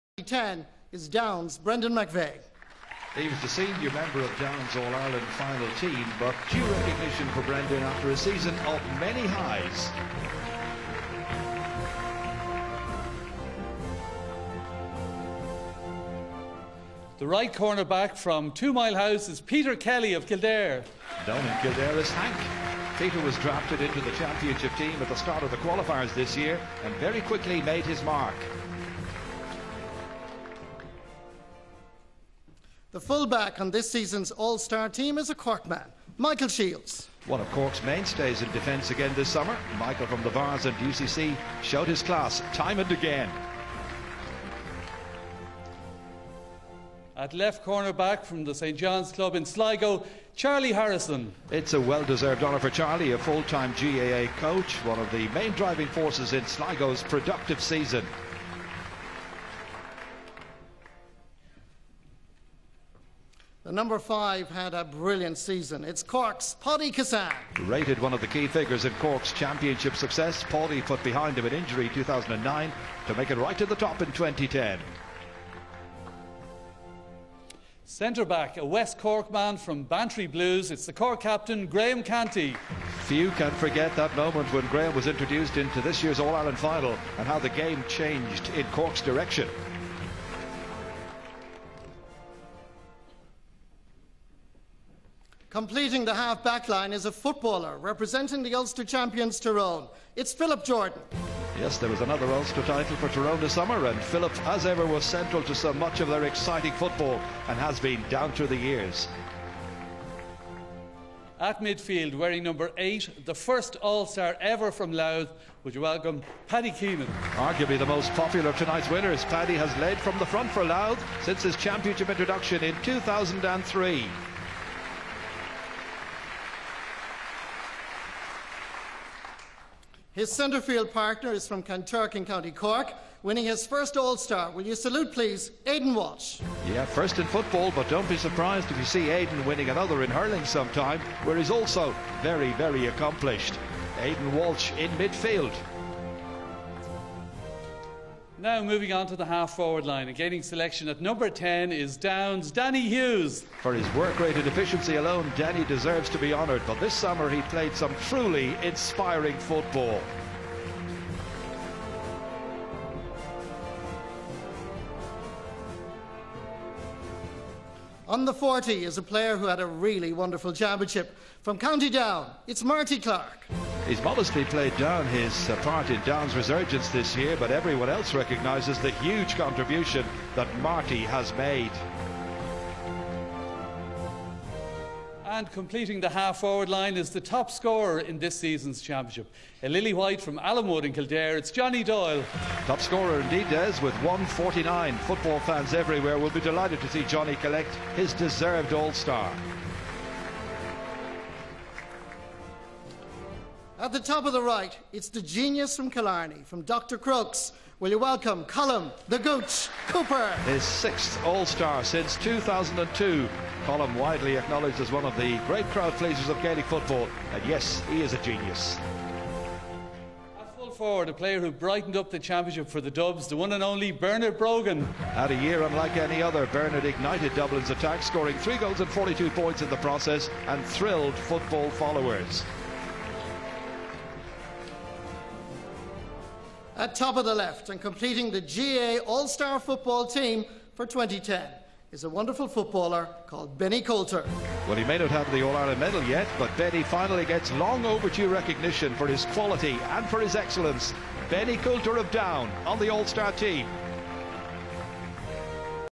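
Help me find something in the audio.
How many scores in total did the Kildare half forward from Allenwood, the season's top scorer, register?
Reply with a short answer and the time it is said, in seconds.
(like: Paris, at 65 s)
149, at 194 s.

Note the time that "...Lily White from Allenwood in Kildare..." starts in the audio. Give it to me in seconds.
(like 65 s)
189 s.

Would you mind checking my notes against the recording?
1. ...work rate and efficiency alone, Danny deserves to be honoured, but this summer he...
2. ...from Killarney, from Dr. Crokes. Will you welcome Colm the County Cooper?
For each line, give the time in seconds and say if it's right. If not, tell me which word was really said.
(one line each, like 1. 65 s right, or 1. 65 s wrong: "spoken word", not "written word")
1. 153 s right
2. 205 s wrong: "Gooch", not "County".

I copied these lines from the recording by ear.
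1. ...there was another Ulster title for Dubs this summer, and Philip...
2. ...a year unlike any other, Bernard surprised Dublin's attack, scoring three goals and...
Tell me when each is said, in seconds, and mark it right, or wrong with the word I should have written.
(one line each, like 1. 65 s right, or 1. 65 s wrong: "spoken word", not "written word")
1. 101 s wrong: "Tyrone", not "Dubs"
2. 225 s wrong: "ignited", not "surprised".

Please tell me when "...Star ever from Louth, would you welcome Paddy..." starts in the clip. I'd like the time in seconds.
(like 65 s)
114 s.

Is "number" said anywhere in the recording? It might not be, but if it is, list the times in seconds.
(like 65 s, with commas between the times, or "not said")
63 s, 112 s, 150 s.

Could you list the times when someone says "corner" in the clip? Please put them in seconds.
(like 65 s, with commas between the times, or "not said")
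17 s, 47 s.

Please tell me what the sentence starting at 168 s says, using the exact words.
On the 40 is a player who had a really wonderful championship.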